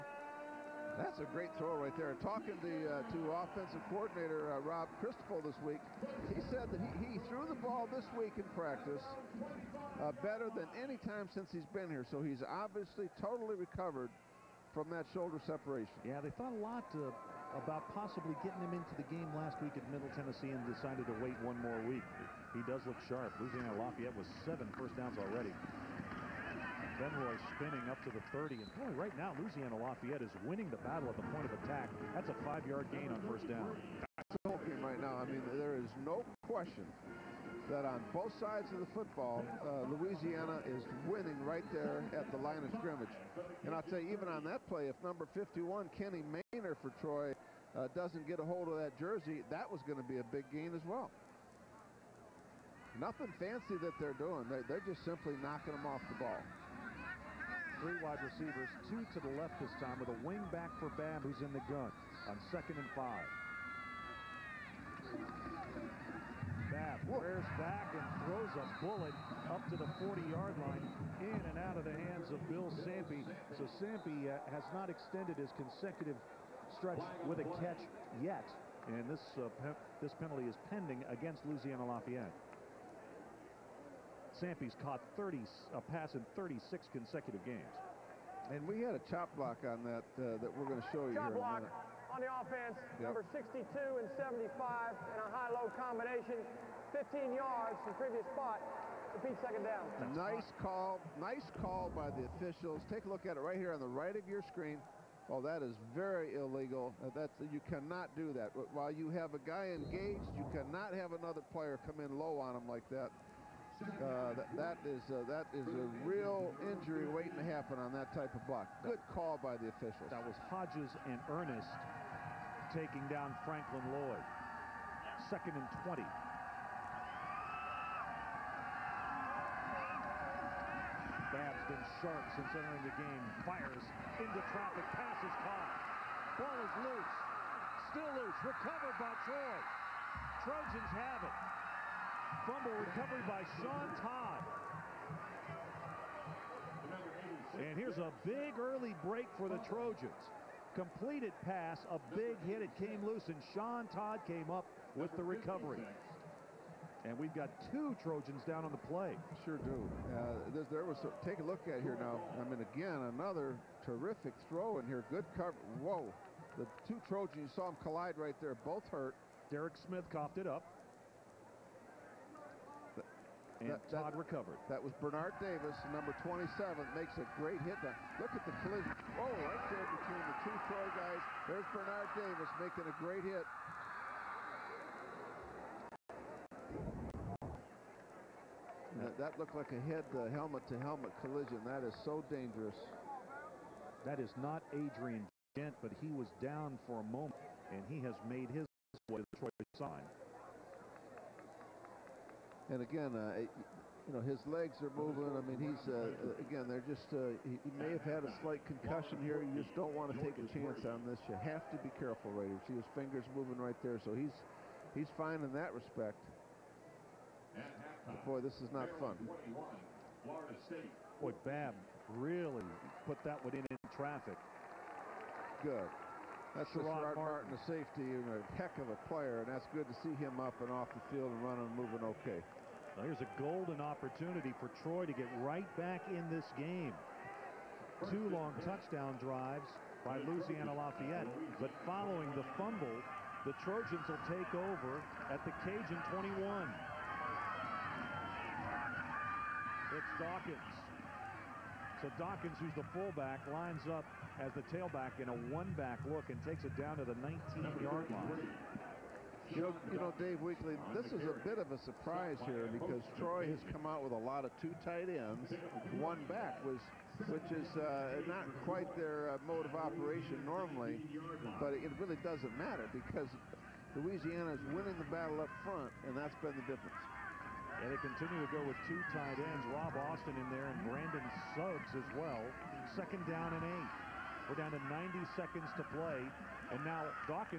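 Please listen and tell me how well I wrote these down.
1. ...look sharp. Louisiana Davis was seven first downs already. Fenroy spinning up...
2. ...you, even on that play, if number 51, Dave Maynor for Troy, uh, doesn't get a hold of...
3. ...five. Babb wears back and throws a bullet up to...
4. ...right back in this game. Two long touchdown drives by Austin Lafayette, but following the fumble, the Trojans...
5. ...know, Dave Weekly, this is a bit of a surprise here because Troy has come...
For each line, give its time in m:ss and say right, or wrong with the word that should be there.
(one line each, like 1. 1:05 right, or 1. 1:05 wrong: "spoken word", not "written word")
1. 0:22 wrong: "Lafayette", not "Davis"
2. 0:44 wrong: "Kenny", not "Dave"
3. 1:02 right
4. 3:55 wrong: "Louisiana", not "Austin"
5. 4:20 right.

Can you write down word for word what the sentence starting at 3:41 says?
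Boy, Babb really put that one in in traffic.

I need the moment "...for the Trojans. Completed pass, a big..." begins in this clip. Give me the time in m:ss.
2:29.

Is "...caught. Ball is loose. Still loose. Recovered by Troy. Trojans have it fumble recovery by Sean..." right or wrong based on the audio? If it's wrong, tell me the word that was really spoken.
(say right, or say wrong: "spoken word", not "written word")
right.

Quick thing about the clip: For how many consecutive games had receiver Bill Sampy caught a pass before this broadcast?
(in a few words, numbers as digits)
36.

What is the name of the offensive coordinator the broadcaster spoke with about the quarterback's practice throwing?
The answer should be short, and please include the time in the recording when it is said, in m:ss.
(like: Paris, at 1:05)
Rob Christopher, at 0:04.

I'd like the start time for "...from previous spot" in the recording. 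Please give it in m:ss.
1:37.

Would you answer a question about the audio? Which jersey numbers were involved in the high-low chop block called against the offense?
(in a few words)
62 and 75.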